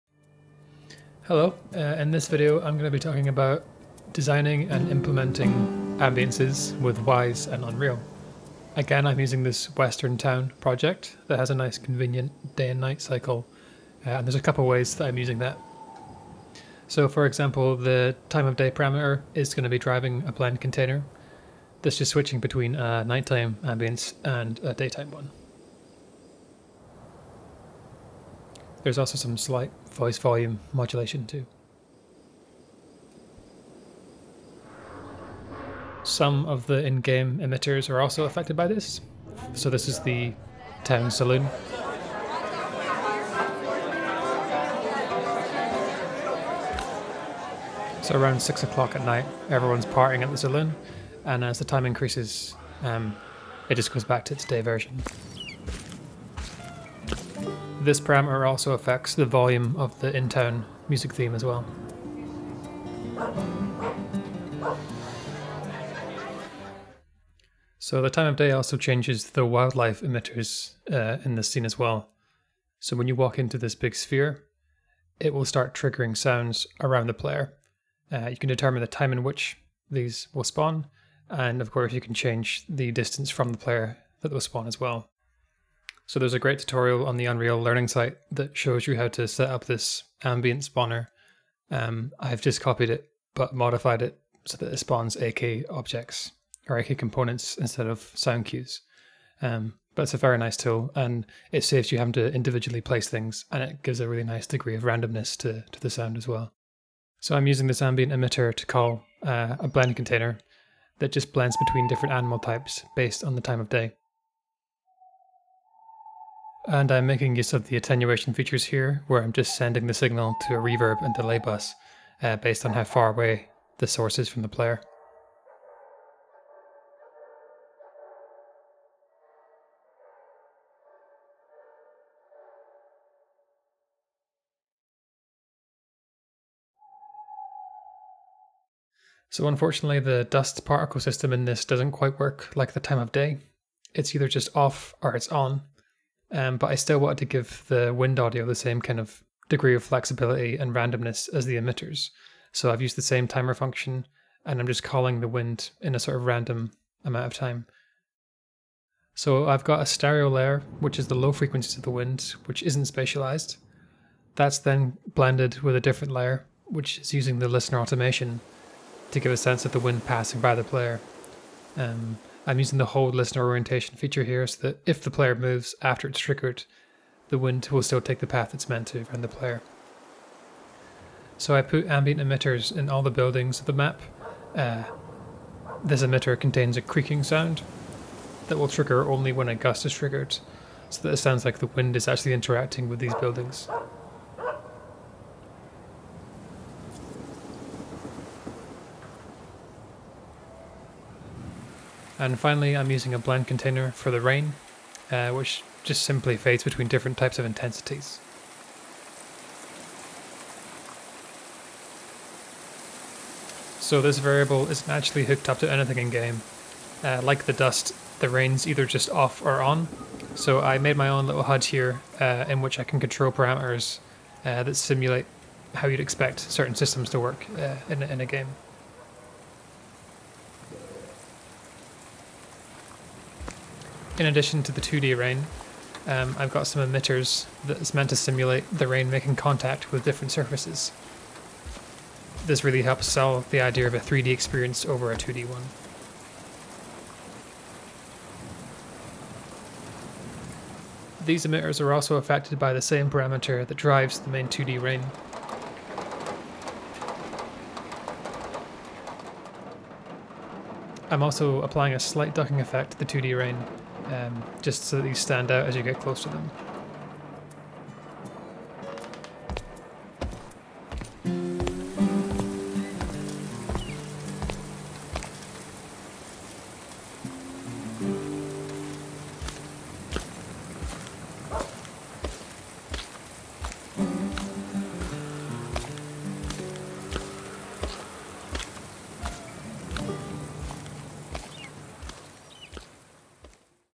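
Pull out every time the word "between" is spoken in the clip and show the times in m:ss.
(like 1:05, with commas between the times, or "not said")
0:22, 1:51, 3:26.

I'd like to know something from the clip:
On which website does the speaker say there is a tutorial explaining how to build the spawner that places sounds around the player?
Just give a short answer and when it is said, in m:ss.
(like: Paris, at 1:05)
Unreal Learning site, at 1:27.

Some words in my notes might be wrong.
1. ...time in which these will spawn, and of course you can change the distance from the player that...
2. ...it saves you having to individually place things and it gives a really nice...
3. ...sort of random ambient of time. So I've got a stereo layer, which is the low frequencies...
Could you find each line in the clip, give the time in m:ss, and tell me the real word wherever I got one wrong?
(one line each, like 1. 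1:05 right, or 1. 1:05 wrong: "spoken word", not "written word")
1. 1:18 right
2. 1:41 right
3. 2:35 wrong: "amount", not "ambient".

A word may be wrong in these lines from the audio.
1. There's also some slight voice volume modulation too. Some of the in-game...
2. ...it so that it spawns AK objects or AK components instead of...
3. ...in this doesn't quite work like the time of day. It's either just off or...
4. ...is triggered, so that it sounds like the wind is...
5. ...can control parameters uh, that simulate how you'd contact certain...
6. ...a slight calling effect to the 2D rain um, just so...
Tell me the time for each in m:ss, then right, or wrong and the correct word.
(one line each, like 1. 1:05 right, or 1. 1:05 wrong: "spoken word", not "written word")
1. 0:28 right
2. 1:34 right
3. 2:21 right
4. 3:09 right
5. 3:42 wrong: "expect", not "contact"
6. 4:21 wrong: "ducking", not "calling".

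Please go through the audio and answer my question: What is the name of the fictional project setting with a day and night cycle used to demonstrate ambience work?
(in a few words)
Western Town.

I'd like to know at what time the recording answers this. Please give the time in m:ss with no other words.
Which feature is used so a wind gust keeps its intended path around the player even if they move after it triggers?
2:52.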